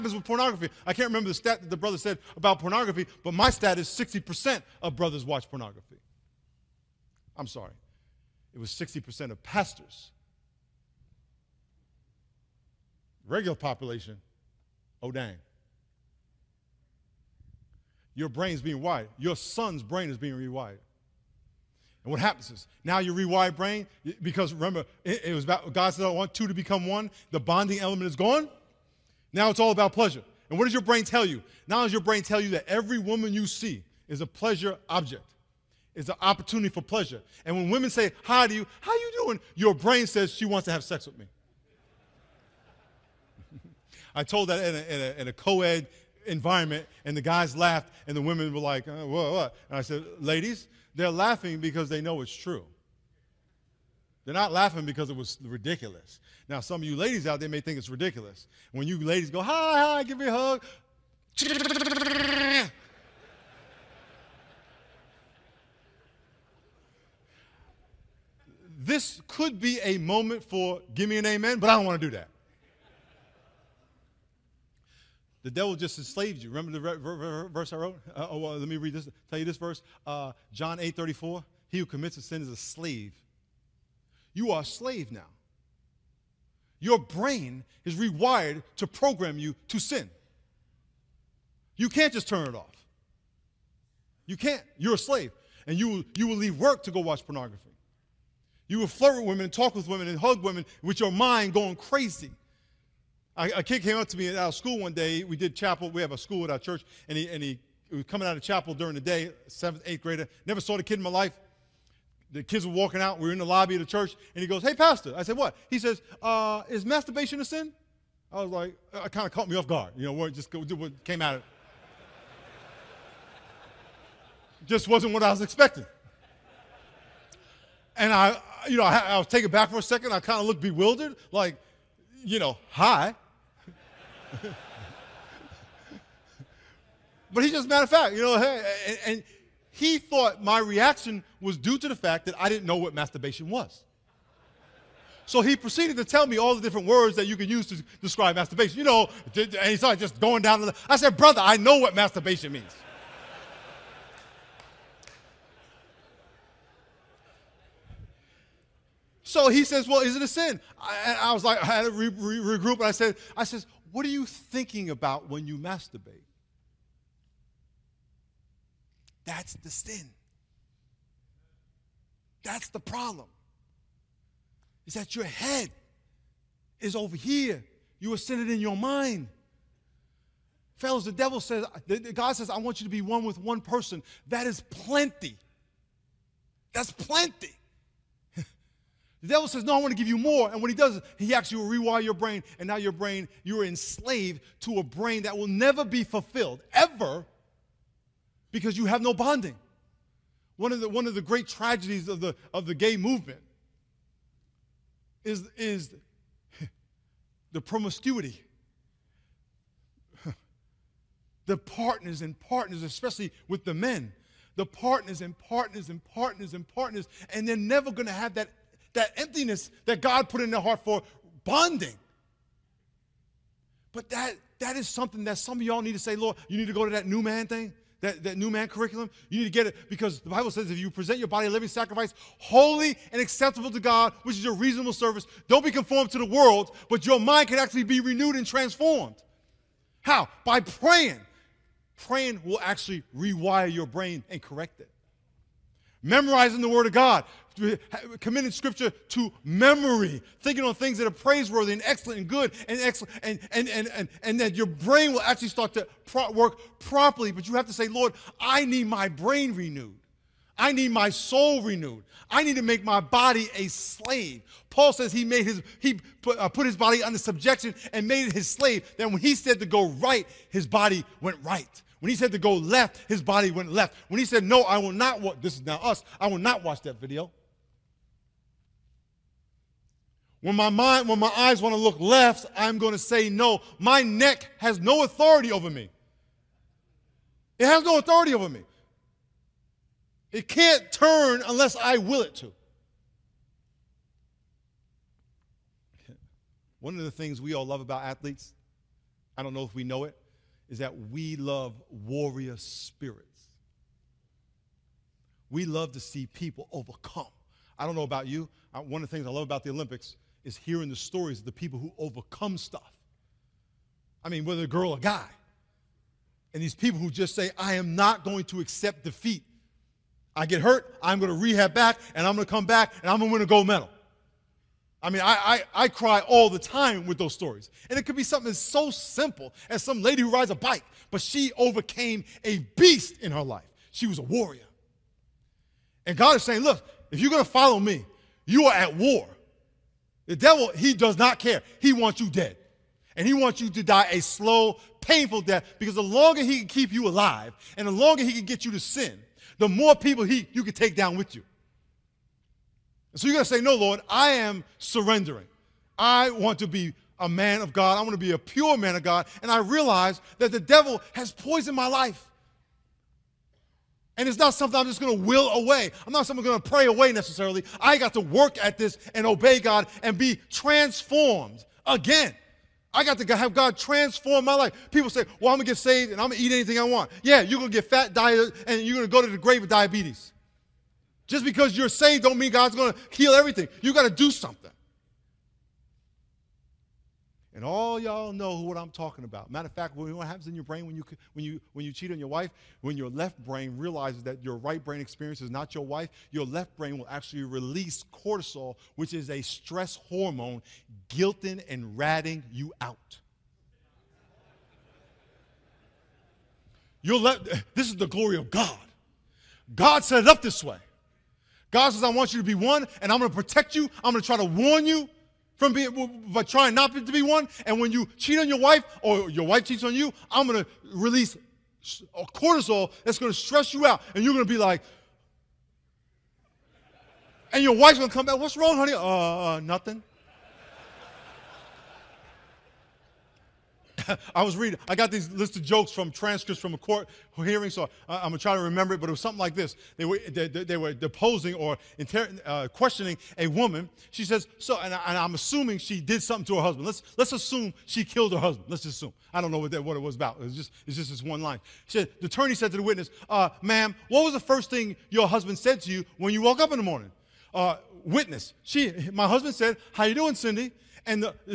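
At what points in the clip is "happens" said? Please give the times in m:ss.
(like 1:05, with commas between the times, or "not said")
0:22, 6:30.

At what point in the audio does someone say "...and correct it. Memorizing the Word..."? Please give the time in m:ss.
4:04.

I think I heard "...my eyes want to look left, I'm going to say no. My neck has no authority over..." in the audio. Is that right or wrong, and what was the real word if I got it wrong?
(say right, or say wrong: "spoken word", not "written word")
right.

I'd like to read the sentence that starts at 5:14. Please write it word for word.
I mean, whether a girl or guy.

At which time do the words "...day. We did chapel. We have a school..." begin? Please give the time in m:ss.
1:44.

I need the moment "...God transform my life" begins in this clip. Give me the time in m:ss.
6:13.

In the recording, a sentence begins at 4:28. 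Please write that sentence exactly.
Then when he said to go right, his body went right.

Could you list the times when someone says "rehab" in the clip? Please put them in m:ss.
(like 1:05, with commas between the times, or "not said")
5:21.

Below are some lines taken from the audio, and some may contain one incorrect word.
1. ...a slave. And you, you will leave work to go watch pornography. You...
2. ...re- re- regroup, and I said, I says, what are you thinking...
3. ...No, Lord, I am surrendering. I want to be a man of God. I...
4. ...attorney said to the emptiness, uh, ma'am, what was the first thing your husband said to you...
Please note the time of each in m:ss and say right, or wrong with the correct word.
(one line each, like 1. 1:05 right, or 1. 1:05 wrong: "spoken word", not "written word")
1. 1:34 right
2. 2:41 right
3. 5:53 right
4. 7:32 wrong: "witness", not "emptiness".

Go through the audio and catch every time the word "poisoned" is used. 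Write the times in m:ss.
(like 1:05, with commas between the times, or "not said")
6:01.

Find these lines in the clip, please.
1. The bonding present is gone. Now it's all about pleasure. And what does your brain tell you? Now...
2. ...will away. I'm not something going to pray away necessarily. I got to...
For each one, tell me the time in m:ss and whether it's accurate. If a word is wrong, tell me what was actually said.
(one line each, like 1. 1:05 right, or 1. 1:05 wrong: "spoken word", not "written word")
1. 0:27 wrong: "element", not "present"
2. 6:05 right.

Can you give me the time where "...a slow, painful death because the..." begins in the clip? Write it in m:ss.
5:44.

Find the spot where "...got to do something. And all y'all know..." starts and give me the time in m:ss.
6:23.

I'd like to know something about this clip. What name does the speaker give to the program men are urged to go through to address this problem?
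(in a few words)
new man curriculum.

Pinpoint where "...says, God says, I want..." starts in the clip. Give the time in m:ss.
3:01.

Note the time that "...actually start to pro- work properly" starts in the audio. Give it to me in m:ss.
4:15.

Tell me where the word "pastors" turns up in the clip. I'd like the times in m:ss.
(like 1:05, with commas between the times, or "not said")
0:09, 1:54.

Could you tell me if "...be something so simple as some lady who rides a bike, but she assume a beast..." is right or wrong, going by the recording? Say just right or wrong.
wrong.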